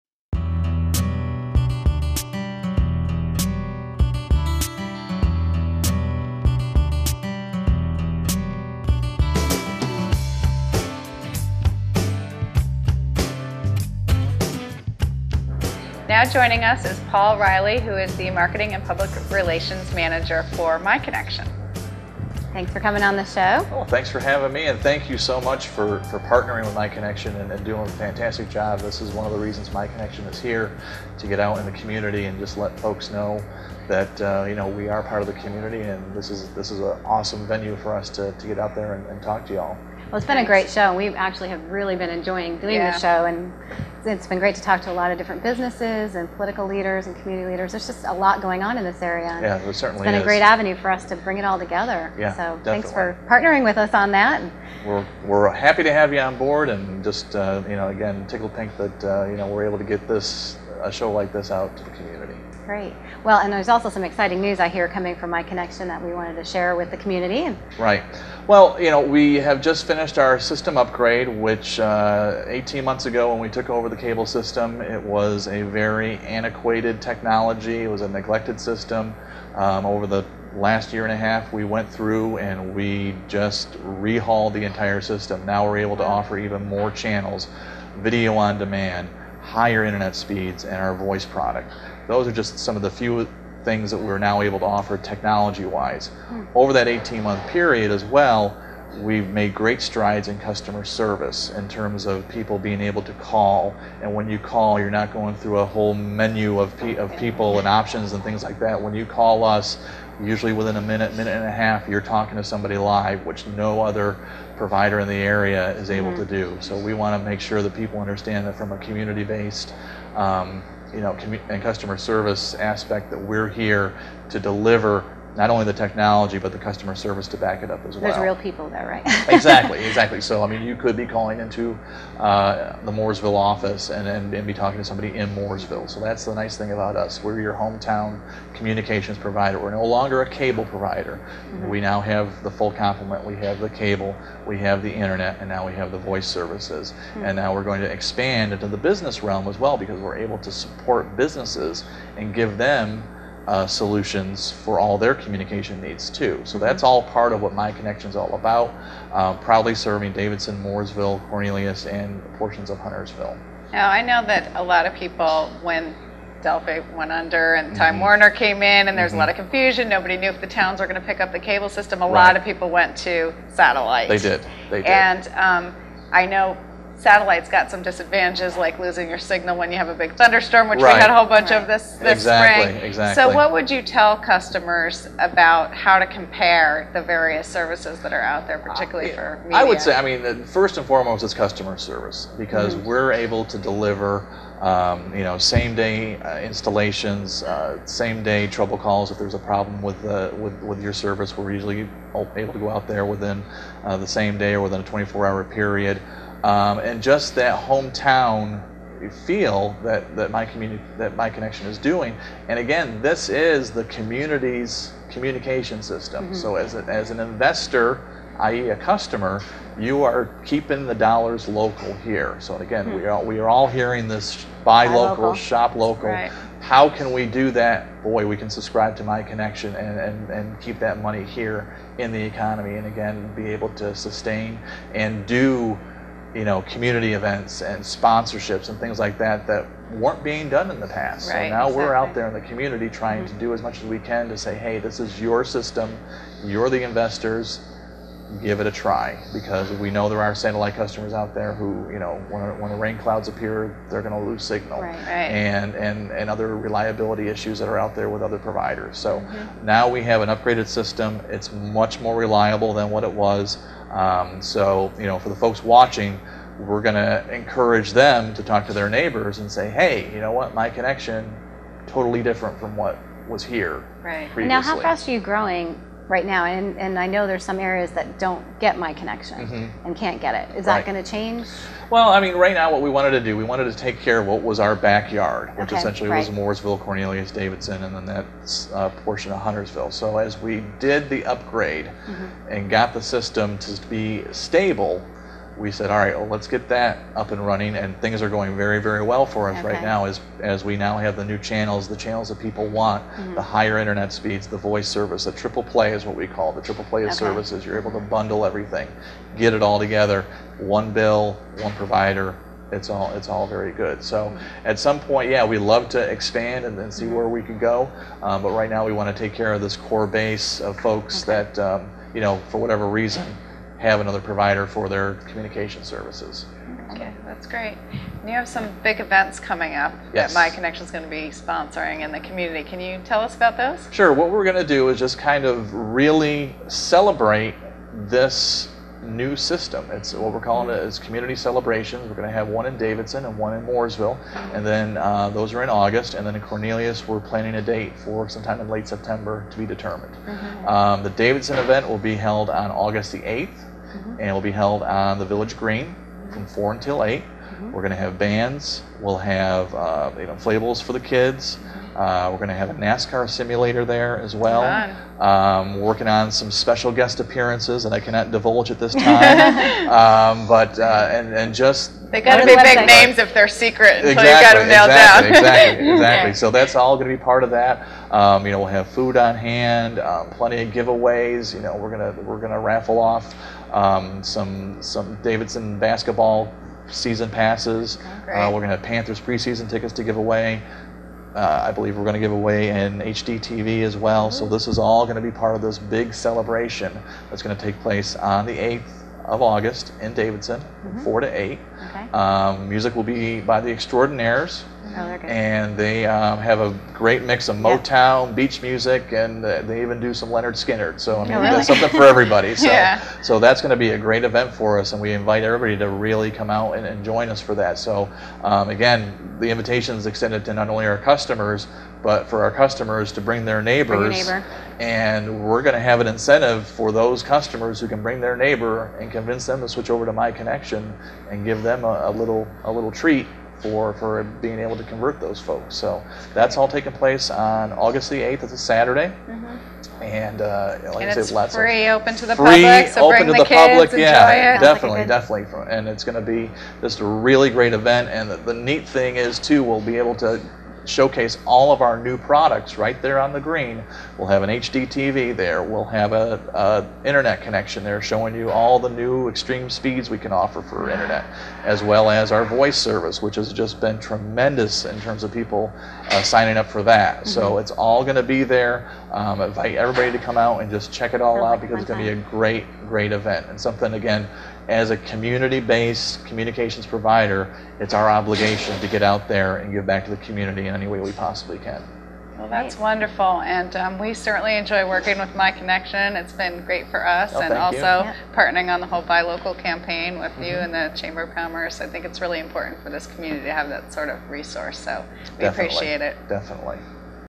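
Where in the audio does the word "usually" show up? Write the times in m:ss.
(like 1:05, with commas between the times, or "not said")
1:50, 3:21.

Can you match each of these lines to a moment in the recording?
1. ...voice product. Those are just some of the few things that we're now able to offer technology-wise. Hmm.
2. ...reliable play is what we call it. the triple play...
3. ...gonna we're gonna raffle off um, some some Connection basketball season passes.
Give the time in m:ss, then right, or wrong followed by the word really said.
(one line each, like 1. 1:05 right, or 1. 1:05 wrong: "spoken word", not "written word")
1. 1:30 right
2. 5:05 wrong: "triple", not "reliable"
3. 6:21 wrong: "Davidson", not "Connection".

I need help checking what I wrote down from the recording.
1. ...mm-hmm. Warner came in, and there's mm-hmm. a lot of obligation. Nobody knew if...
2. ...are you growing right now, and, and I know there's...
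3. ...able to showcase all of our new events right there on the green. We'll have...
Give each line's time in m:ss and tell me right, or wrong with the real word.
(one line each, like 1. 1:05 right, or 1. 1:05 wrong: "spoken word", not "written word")
1. 2:47 wrong: "confusion", not "obligation"
2. 4:35 right
3. 7:29 wrong: "products", not "events".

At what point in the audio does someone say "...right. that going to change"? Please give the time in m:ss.
4:40.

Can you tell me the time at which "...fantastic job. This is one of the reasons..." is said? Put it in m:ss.
0:27.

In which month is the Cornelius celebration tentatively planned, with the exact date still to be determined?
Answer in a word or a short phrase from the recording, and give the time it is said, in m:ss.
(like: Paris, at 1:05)
September, at 5:48.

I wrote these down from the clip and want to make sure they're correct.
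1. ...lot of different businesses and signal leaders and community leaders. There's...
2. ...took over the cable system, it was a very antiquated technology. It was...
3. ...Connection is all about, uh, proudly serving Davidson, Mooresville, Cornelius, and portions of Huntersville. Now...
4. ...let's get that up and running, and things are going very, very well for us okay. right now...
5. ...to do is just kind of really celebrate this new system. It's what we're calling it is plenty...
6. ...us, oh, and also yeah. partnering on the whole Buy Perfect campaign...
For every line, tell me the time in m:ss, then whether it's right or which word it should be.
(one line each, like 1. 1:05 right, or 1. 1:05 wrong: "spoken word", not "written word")
1. 0:44 wrong: "political", not "signal"
2. 1:13 right
3. 2:37 right
4. 4:56 right
5. 5:34 wrong: "community", not "plenty"
6. 8:07 wrong: "Local", not "Perfect".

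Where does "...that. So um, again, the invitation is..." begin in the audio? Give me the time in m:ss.
6:57.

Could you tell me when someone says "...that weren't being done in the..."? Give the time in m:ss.
3:59.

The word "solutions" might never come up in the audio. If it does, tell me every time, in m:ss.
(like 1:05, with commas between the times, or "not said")
2:33.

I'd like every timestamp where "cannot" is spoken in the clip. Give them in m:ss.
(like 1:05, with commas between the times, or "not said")
6:07.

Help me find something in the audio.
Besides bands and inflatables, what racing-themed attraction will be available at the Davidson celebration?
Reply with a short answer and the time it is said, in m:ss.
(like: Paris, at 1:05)
NASCAR simulator, at 6:02.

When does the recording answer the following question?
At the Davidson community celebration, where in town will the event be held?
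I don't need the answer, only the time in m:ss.
5:55.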